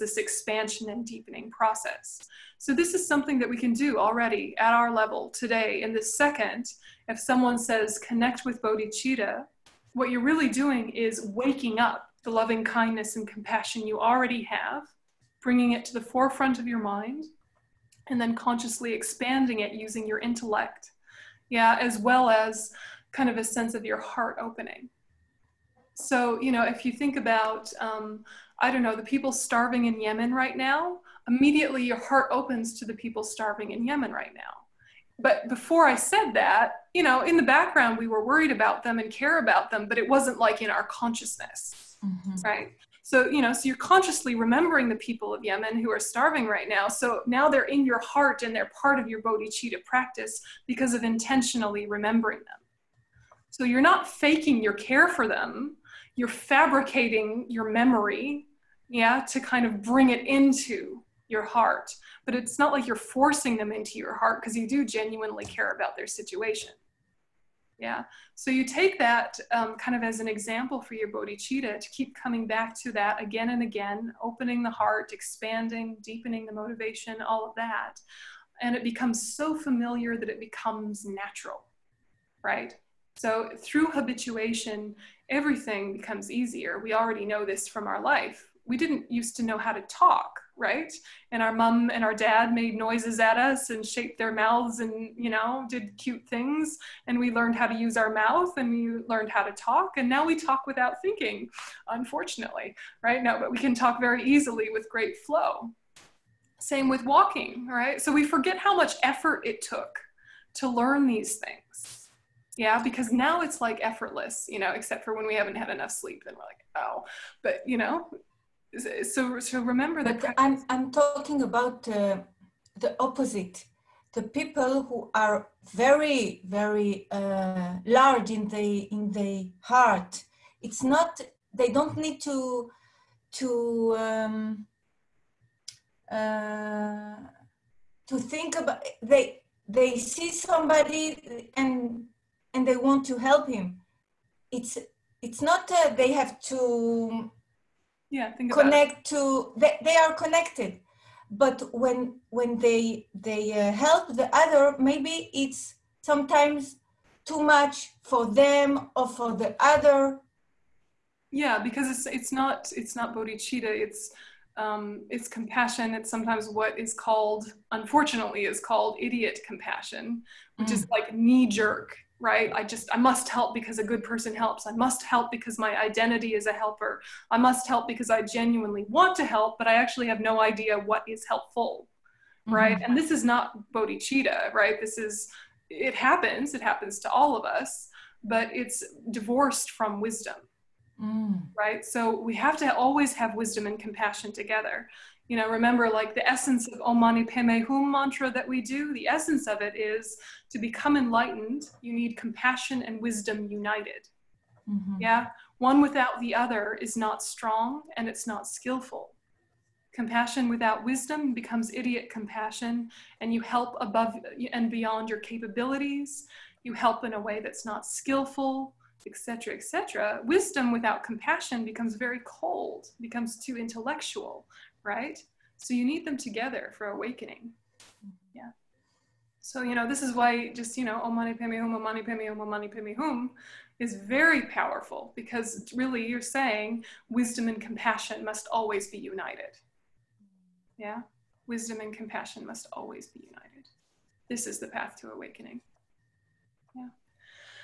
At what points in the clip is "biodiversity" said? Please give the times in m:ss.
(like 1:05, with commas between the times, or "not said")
not said.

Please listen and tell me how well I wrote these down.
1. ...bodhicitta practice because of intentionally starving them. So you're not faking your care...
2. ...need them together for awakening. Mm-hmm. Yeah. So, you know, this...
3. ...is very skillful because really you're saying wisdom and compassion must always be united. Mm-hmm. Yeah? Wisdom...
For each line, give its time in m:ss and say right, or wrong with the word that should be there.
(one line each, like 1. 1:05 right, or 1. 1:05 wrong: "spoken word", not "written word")
1. 0:49 wrong: "remembering", not "starving"
2. 3:45 right
3. 3:53 wrong: "powerful", not "skillful".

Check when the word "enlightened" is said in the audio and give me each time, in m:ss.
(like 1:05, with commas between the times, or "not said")
3:20.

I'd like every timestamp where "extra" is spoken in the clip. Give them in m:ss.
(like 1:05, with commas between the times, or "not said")
not said.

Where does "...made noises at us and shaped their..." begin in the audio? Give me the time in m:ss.
1:32.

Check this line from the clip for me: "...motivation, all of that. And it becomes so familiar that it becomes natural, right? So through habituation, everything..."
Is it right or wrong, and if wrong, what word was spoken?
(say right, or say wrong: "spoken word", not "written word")
right.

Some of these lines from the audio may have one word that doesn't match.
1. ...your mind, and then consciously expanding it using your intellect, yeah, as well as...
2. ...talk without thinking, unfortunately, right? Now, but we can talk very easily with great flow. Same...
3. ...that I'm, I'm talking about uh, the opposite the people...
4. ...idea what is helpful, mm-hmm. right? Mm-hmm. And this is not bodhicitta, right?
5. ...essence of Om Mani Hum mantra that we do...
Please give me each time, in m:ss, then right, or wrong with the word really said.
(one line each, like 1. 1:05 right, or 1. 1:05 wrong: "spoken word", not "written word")
1. 0:16 right
2. 1:40 right
3. 2:00 right
4. 3:00 right
5. 3:16 right.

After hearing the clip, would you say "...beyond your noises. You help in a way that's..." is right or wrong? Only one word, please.
wrong.